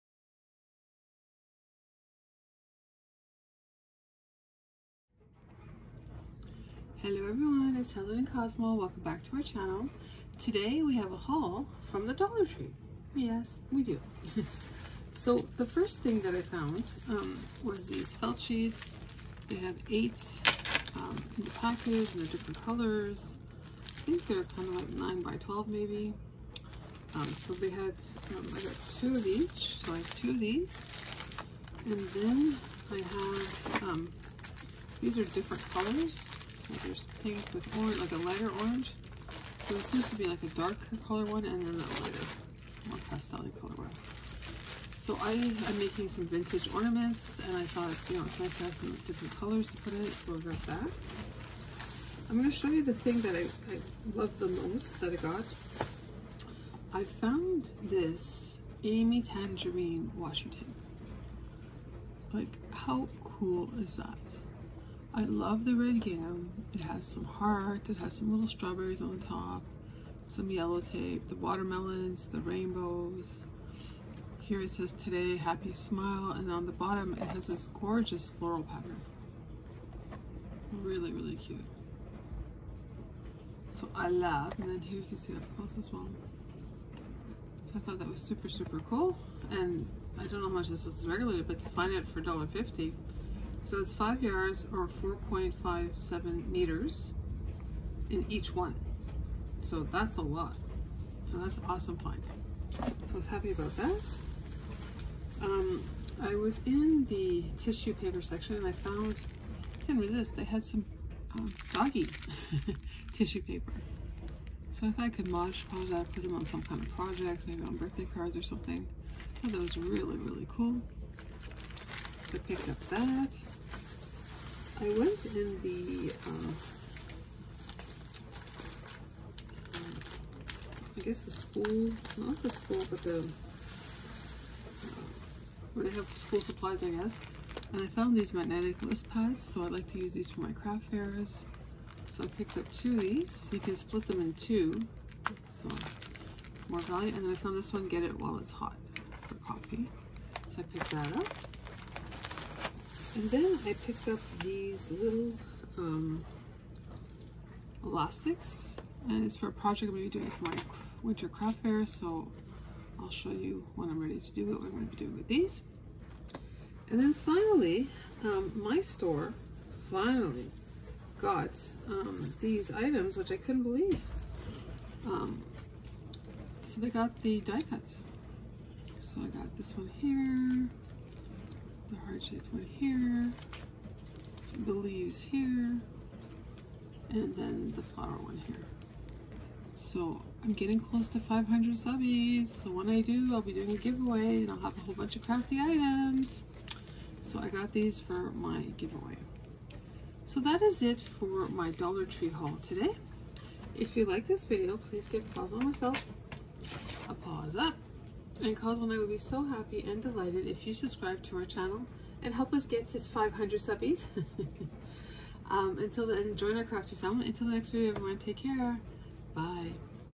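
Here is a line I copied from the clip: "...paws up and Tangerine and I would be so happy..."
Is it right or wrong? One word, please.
wrong.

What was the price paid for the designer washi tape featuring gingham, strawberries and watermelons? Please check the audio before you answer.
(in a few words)
$1.50.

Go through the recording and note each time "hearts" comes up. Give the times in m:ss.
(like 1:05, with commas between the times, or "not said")
1:07, 3:02.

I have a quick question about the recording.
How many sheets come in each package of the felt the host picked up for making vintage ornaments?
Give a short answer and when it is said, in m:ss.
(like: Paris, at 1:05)
8, at 0:19.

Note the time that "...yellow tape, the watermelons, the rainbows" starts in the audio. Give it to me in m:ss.
1:10.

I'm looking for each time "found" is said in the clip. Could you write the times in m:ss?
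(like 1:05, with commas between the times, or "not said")
0:16, 0:57, 1:48, 2:17, 2:27.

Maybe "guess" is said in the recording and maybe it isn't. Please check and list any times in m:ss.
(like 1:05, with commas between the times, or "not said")
2:11, 2:16.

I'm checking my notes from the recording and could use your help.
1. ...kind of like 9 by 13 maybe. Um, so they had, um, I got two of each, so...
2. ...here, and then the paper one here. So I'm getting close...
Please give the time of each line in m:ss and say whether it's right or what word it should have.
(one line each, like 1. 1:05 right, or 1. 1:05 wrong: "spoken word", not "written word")
1. 0:24 wrong: "12", not "13"
2. 3:05 wrong: "flower", not "paper".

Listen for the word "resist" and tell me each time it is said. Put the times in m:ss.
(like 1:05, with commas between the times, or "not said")
1:50.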